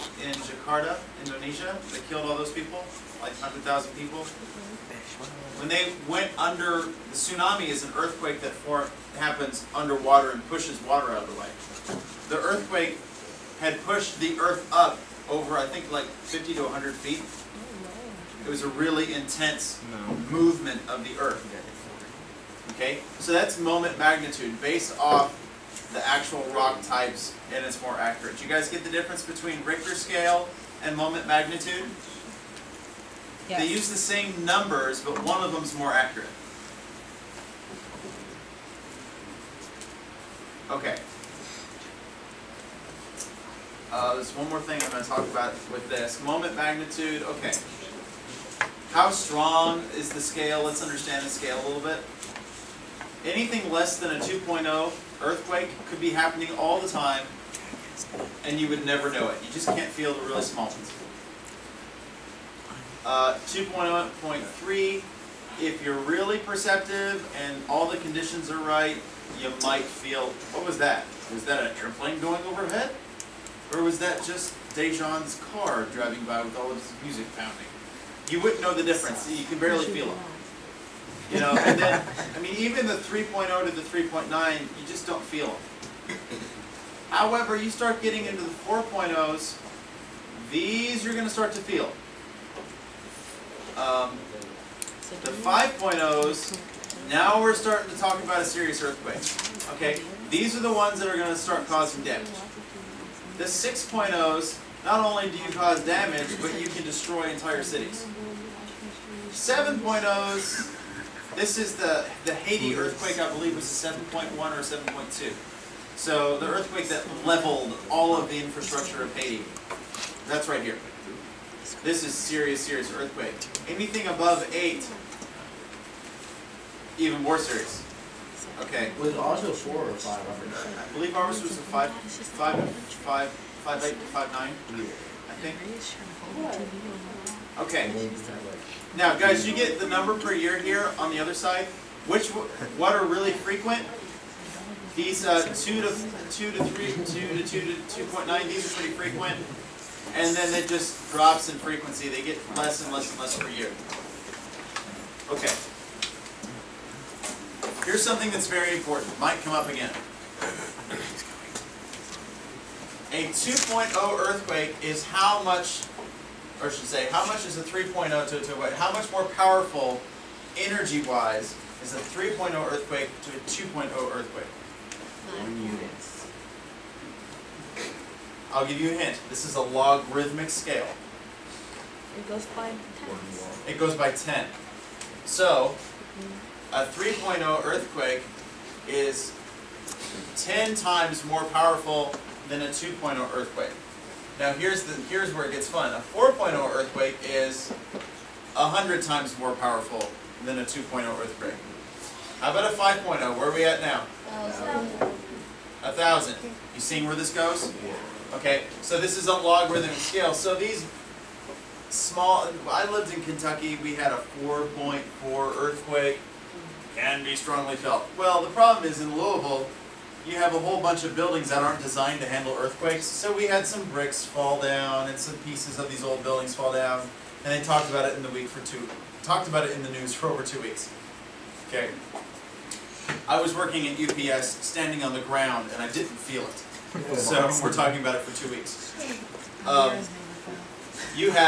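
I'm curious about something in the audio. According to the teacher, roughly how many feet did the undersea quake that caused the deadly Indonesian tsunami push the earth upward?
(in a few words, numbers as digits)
50 to 100 feet.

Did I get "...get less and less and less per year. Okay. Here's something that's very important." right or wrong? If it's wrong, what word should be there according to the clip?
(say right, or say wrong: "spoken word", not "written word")
right.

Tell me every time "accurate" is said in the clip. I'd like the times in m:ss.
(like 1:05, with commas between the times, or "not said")
0:27, 0:35.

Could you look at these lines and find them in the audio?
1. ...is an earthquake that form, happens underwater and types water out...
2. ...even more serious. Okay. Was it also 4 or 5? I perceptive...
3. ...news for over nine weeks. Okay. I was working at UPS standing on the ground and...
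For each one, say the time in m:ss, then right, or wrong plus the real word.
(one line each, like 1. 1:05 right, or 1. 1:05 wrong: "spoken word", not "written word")
1. 0:07 wrong: "pushes", not "types"
2. 2:06 wrong: "believe", not "perceptive"
3. 3:49 wrong: "two", not "nine".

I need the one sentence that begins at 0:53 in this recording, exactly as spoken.
Anything less than a 2.0 Earthquake could be happening all the time, and you would never know it.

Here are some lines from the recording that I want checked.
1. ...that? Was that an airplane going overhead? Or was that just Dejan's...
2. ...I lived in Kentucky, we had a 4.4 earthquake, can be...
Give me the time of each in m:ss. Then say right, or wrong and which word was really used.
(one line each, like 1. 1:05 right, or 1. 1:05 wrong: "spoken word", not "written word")
1. 1:10 right
2. 3:32 right.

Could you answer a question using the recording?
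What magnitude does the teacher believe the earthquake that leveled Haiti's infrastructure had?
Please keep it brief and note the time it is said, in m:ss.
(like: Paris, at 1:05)
7.1 or 7.2, at 1:53.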